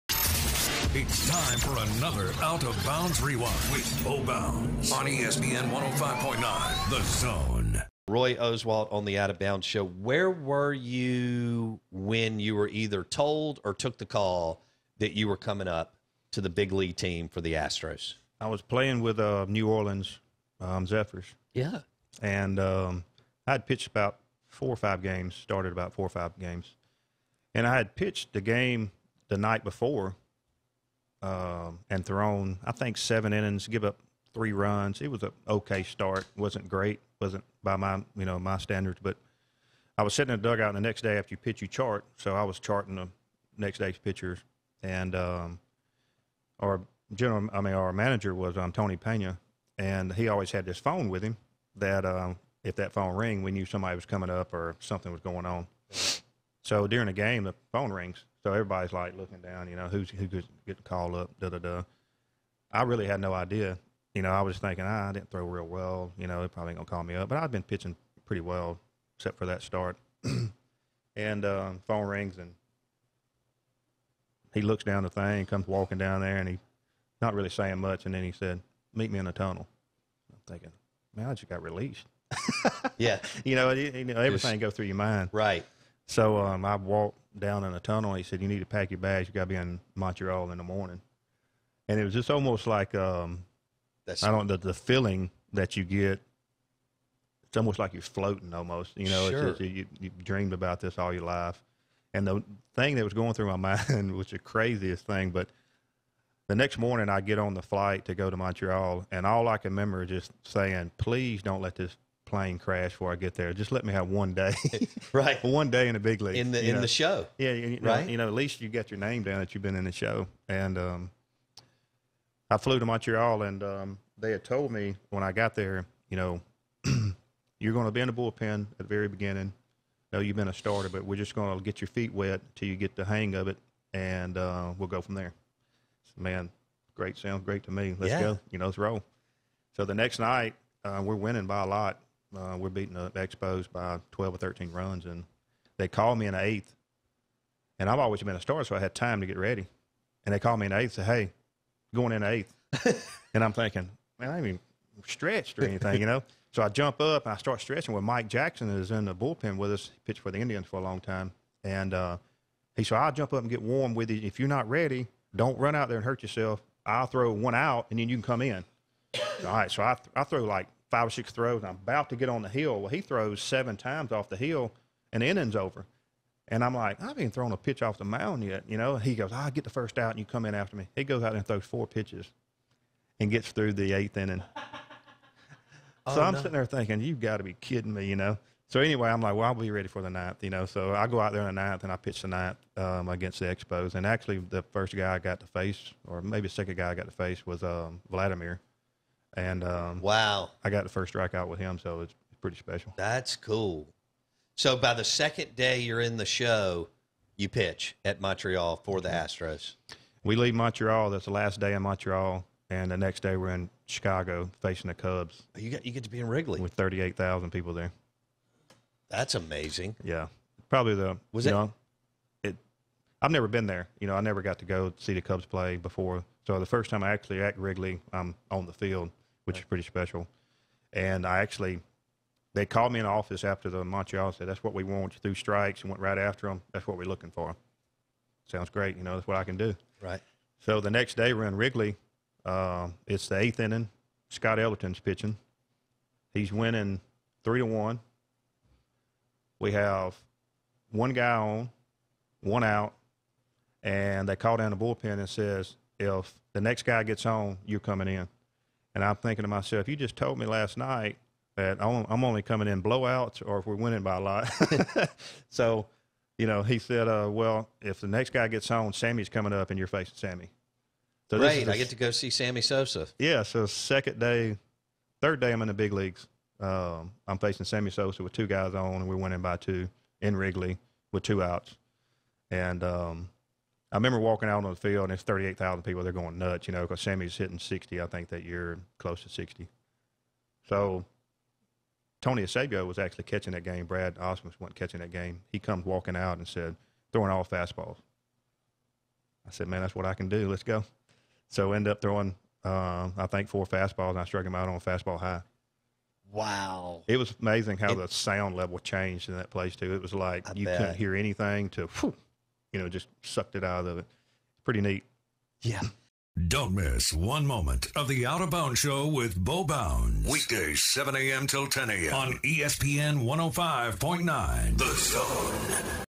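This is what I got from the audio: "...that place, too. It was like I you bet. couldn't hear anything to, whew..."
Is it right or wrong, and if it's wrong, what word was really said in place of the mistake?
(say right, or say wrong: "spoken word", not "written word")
right.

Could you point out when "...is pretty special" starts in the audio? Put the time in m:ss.
3:49.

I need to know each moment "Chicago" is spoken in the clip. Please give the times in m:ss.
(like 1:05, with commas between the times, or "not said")
3:33.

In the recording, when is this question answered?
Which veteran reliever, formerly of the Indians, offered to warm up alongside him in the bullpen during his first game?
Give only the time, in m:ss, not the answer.
2:38.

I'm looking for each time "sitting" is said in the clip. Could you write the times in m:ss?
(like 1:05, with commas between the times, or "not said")
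0:40, 3:06.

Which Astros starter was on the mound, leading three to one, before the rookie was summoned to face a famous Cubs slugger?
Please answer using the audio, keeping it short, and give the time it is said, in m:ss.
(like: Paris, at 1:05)
Scott Elarton, at 4:04.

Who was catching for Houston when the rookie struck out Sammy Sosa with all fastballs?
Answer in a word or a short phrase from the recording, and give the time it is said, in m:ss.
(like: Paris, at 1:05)
Tony Eusebio, at 4:52.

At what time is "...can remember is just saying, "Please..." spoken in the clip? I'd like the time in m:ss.
1:49.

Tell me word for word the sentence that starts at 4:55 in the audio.
He comes walking out and said, throwing all fastballs.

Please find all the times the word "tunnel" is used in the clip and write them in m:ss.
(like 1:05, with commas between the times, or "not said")
1:19, 1:27.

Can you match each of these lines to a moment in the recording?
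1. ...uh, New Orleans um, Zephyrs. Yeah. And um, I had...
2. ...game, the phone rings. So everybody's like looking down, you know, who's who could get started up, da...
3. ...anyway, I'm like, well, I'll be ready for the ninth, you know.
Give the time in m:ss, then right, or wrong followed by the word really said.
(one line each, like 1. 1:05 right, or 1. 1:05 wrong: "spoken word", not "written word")
1. 0:19 right
2. 0:57 wrong: "called", not "started"
3. 3:08 right.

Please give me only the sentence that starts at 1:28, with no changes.
He said, "You need to pack your bags.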